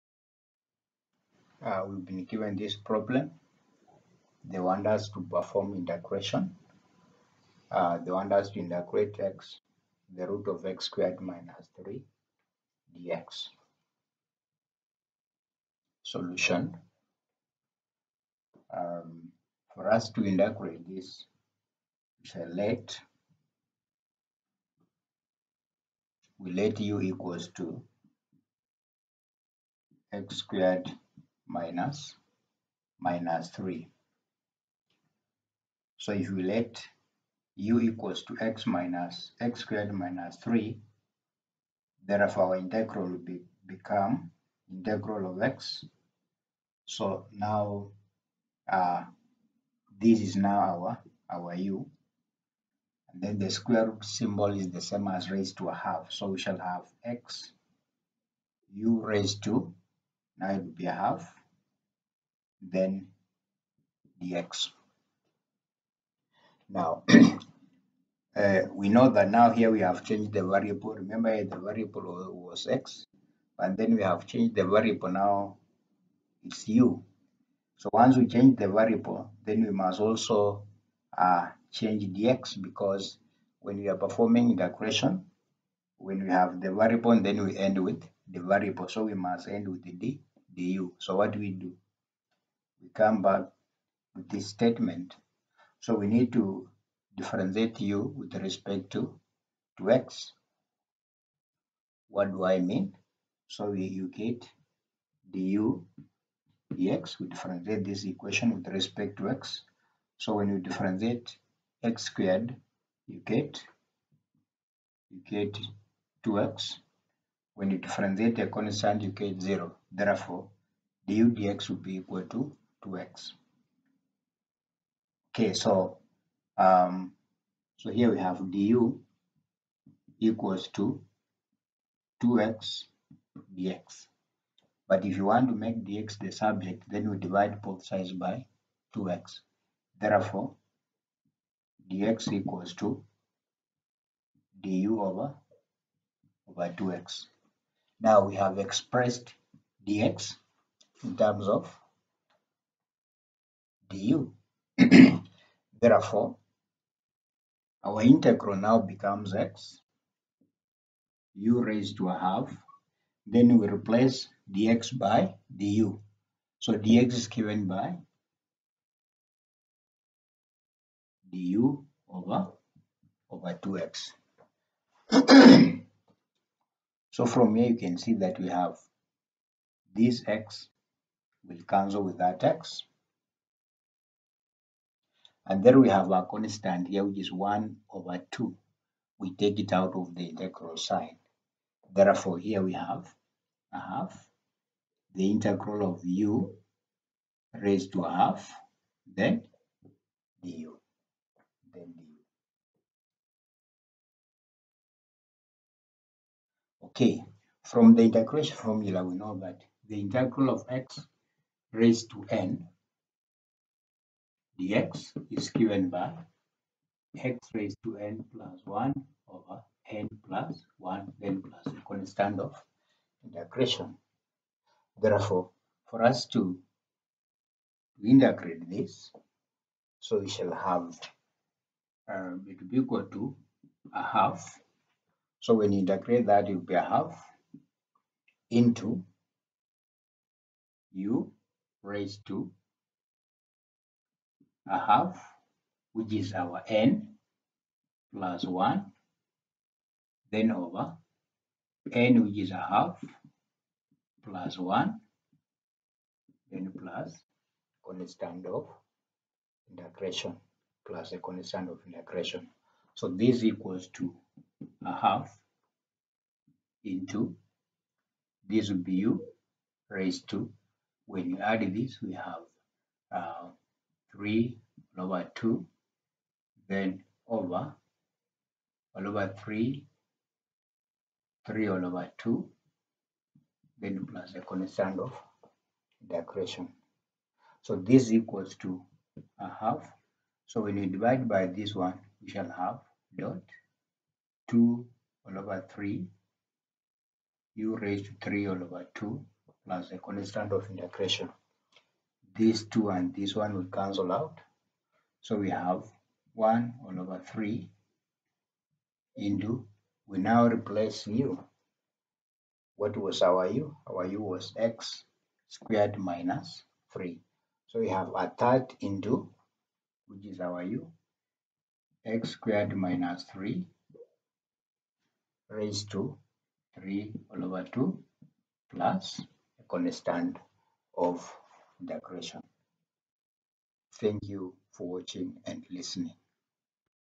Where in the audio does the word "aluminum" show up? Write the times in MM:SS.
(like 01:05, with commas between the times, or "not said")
not said.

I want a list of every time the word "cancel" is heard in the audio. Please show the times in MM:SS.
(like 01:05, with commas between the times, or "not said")
03:01, 05:03.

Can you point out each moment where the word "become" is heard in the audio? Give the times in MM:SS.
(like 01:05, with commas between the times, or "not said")
00:43, 02:38.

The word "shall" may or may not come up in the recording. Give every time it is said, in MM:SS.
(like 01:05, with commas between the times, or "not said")
00:56, 03:50, 04:52.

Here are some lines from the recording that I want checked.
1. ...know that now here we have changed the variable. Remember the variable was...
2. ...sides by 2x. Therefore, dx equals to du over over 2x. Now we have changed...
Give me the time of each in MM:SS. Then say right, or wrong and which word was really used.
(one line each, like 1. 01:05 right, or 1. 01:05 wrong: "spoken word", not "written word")
1. 01:08 right
2. 02:17 wrong: "expressed", not "changed".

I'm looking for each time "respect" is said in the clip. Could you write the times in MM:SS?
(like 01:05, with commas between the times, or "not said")
01:38, 01:48.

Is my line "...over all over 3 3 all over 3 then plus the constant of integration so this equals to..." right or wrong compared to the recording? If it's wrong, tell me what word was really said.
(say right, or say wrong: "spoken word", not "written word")
wrong: "2", not "3".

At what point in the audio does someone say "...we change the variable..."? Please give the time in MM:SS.
01:18.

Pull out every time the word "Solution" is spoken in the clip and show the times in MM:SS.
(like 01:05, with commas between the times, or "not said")
00:16.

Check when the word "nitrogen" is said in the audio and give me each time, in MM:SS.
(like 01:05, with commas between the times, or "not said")
not said.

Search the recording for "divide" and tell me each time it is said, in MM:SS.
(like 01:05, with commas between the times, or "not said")
02:17, 04:50.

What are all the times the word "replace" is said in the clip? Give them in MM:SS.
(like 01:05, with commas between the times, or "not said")
02:43, 05:10.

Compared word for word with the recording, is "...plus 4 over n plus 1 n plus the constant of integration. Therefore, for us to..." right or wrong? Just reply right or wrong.
wrong.